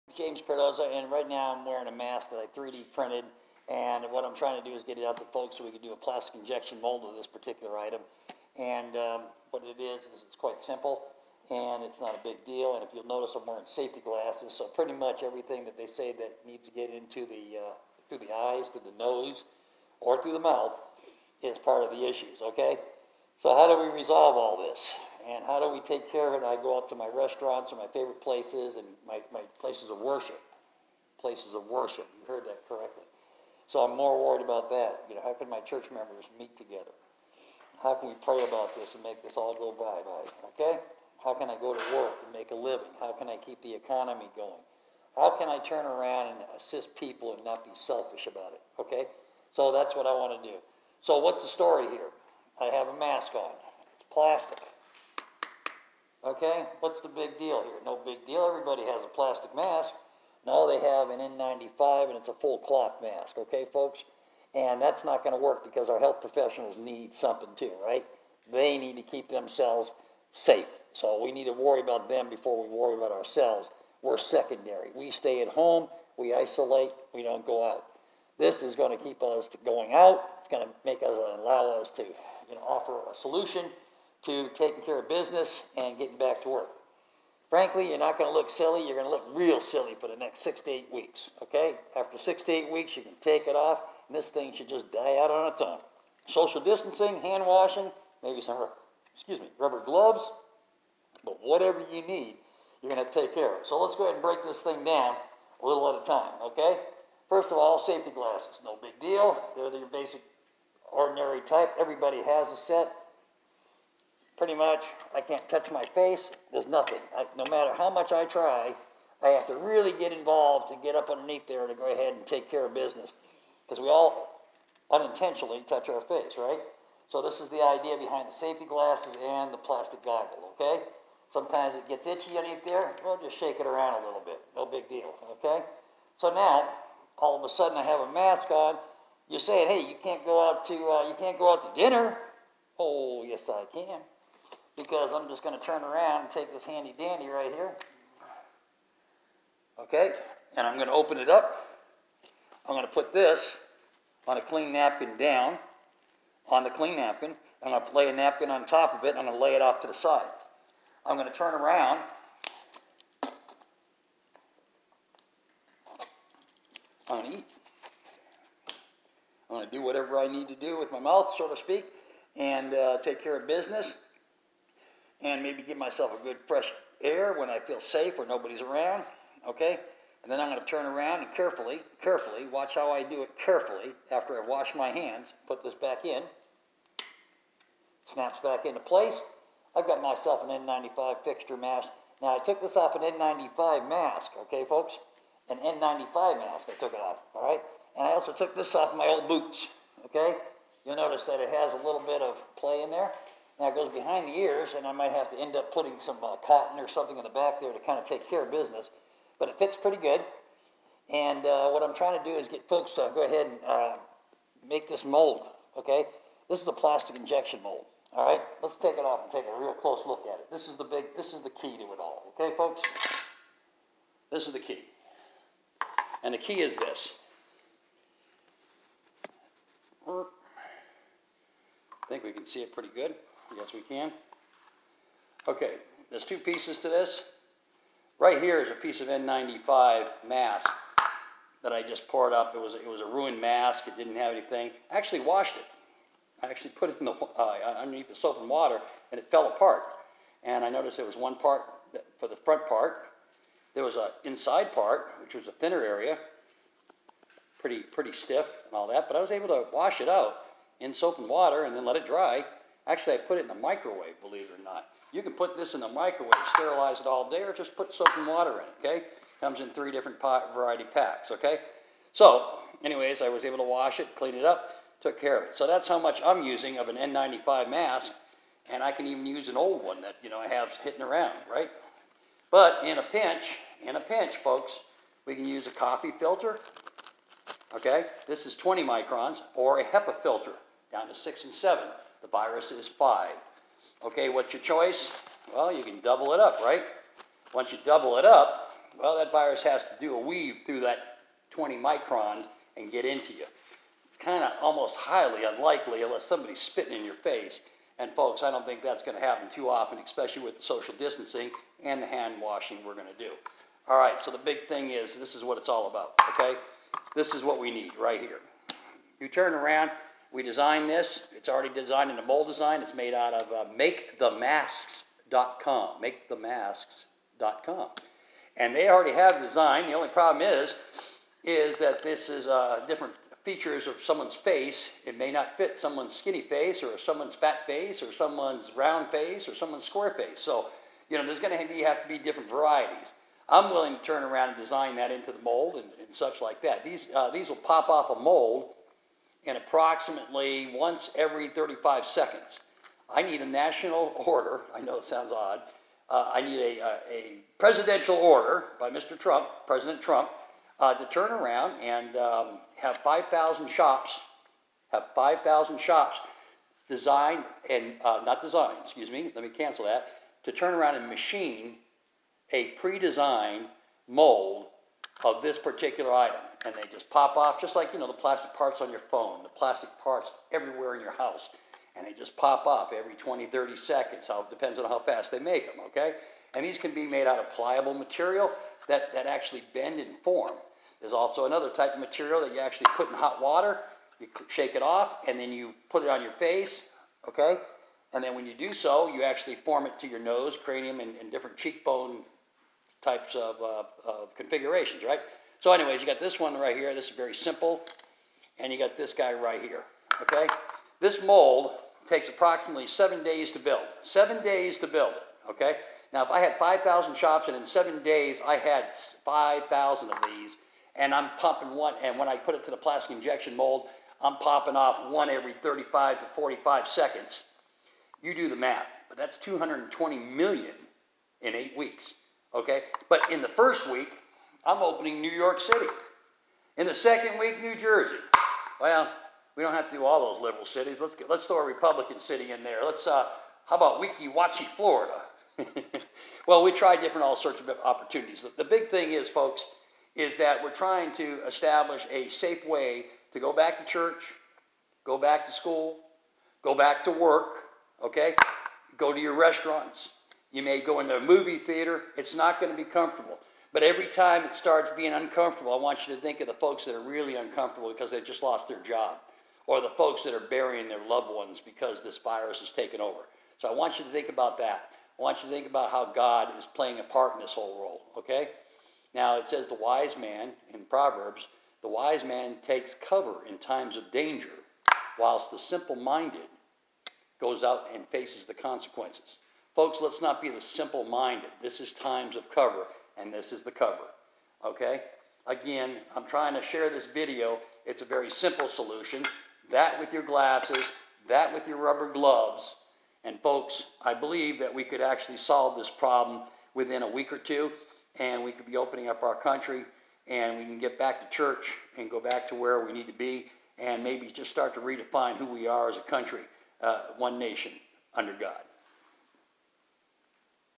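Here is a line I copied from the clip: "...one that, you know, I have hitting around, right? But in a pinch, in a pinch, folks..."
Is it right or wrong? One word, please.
right.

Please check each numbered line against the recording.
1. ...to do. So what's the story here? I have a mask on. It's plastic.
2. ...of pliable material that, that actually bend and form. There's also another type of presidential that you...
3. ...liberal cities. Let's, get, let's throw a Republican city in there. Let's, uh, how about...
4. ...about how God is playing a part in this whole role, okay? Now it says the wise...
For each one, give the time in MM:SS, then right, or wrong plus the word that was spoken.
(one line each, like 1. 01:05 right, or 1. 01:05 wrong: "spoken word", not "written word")
1. 00:50 right
2. 06:27 wrong: "material", not "presidential"
3. 07:20 right
4. 07:55 right.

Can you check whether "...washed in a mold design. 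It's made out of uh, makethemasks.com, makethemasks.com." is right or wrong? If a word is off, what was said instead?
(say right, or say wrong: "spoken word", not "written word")
wrong: "designed", not "washed".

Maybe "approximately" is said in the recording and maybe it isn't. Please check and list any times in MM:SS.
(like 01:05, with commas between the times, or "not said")
05:49, 06:52.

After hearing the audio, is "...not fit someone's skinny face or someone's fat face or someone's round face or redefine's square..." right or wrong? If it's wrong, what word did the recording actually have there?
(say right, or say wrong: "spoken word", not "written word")
wrong: "someone", not "redefine".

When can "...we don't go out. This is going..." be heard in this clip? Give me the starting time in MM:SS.
01:17.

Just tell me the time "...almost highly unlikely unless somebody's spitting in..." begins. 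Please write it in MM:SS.
05:04.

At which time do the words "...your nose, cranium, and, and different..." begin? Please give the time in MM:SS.
06:40.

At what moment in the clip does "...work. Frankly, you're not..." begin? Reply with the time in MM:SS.
01:26.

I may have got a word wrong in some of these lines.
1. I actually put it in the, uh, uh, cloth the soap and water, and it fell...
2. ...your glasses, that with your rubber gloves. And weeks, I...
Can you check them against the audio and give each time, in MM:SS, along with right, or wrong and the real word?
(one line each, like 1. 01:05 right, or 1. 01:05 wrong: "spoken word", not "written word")
1. 04:06 wrong: "underneath", not "cloth"
2. 08:20 wrong: "folks", not "weeks".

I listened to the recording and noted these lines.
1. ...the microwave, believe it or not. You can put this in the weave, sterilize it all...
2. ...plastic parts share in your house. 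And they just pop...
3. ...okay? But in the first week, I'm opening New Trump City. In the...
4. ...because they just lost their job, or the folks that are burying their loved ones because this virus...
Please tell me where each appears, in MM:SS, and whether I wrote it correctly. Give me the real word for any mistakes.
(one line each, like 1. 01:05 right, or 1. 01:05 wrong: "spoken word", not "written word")
1. 04:23 wrong: "microwave", not "weave"
2. 06:19 wrong: "everywhere", not "share"
3. 07:12 wrong: "York", not "Trump"
4. 07:47 right.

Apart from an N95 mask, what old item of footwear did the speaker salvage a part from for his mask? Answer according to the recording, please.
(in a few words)
Boots.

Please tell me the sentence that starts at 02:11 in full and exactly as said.
Sometimes it gets itchy underneath there.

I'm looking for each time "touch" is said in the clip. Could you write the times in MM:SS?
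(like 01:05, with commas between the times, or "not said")
01:55, 02:05.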